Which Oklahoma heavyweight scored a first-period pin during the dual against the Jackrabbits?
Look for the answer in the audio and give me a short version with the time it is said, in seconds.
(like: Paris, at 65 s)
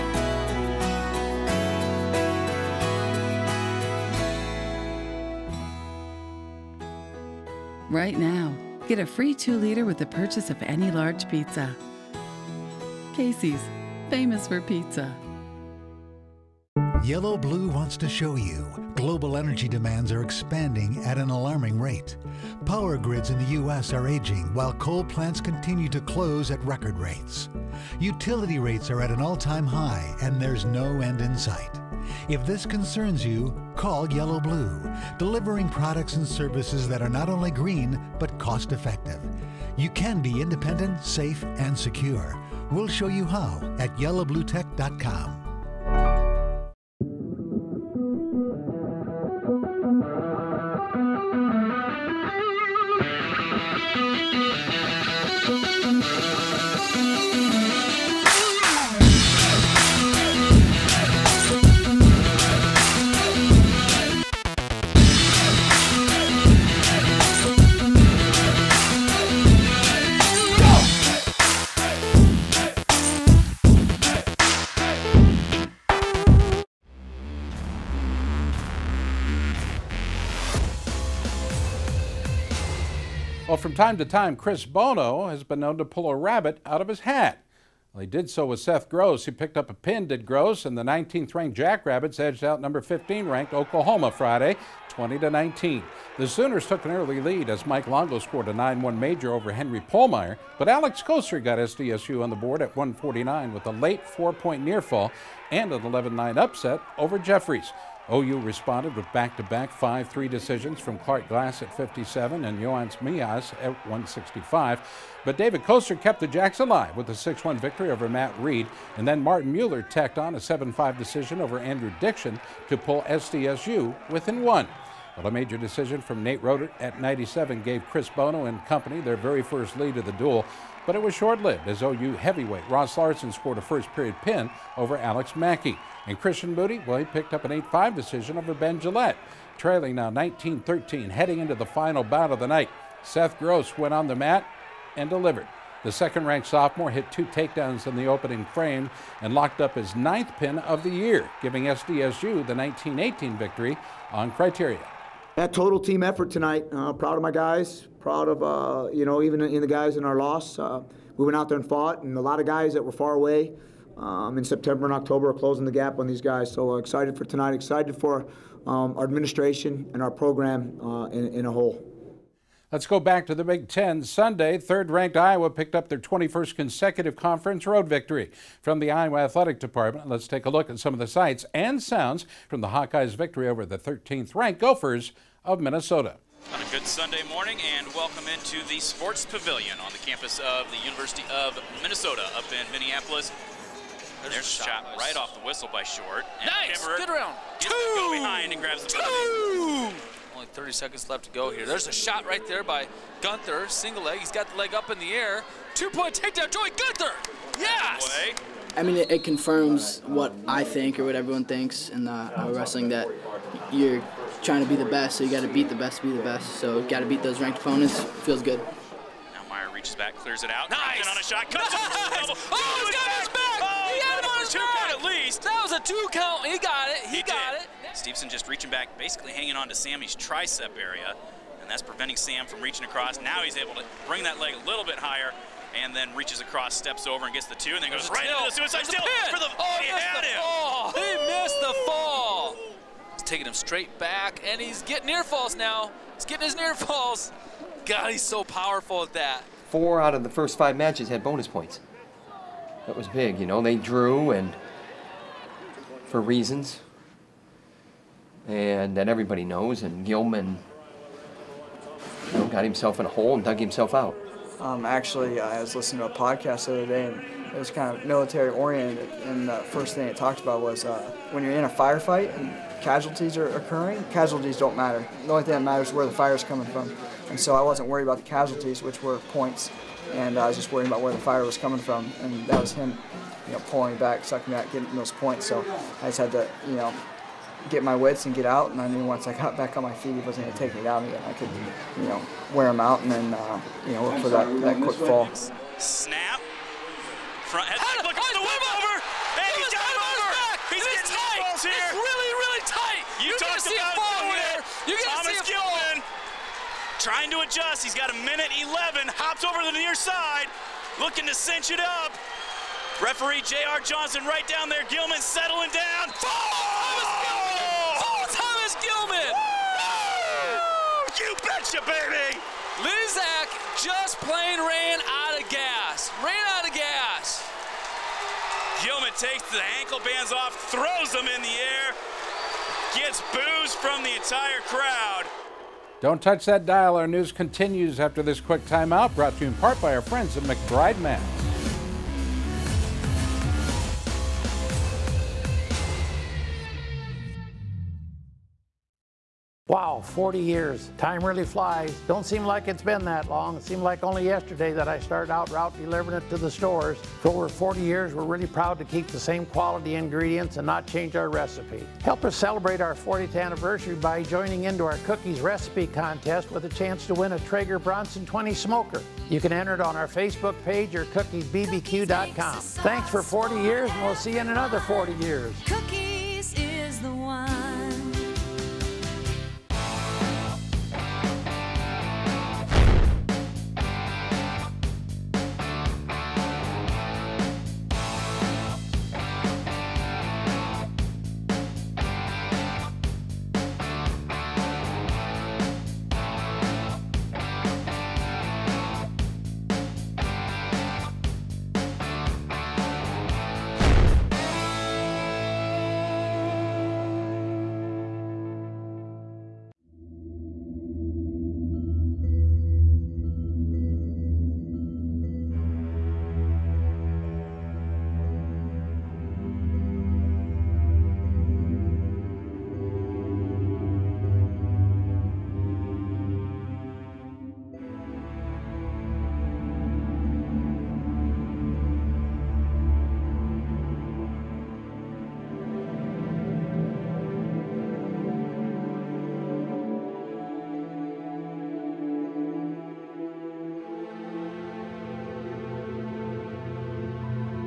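Ross Larson, at 132 s.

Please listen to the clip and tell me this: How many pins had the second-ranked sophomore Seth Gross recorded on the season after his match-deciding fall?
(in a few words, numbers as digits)
9.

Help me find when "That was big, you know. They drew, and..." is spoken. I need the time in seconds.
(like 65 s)
252 s.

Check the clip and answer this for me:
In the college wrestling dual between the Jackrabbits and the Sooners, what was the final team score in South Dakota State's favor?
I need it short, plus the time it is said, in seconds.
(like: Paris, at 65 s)
20 to 19, at 94 s.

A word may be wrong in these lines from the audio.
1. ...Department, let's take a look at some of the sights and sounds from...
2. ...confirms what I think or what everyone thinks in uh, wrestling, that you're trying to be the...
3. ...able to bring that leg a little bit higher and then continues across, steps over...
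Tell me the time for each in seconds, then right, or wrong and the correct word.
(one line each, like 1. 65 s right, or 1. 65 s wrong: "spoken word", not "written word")
1. 179 s right
2. 209 s right
3. 233 s wrong: "reaches", not "continues".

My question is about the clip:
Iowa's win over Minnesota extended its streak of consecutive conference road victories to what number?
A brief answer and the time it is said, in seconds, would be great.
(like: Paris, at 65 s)
21, at 175 s.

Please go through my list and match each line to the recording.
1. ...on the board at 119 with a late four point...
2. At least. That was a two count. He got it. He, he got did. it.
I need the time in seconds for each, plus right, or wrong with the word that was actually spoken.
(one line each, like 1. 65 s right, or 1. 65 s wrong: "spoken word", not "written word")
1. 102 s wrong: "149", not "119"
2. 224 s right.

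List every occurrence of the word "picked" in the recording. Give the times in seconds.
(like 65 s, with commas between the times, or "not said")
89 s, 137 s, 175 s.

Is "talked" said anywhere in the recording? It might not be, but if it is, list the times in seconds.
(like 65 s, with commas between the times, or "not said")
270 s, 303 s.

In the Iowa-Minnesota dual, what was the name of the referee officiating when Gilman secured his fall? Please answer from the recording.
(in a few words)
J.R. Johnson.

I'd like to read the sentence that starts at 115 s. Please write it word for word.
But David Koster kept the Jacks alive with a 6-1 victory over Matt Reed.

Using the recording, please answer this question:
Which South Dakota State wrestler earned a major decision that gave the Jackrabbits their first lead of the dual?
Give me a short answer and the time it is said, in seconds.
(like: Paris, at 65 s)
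Nate Rotert, at 126 s.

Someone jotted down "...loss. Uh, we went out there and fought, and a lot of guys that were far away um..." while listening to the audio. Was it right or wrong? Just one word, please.
right.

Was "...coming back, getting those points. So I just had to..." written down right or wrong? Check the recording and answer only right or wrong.
wrong.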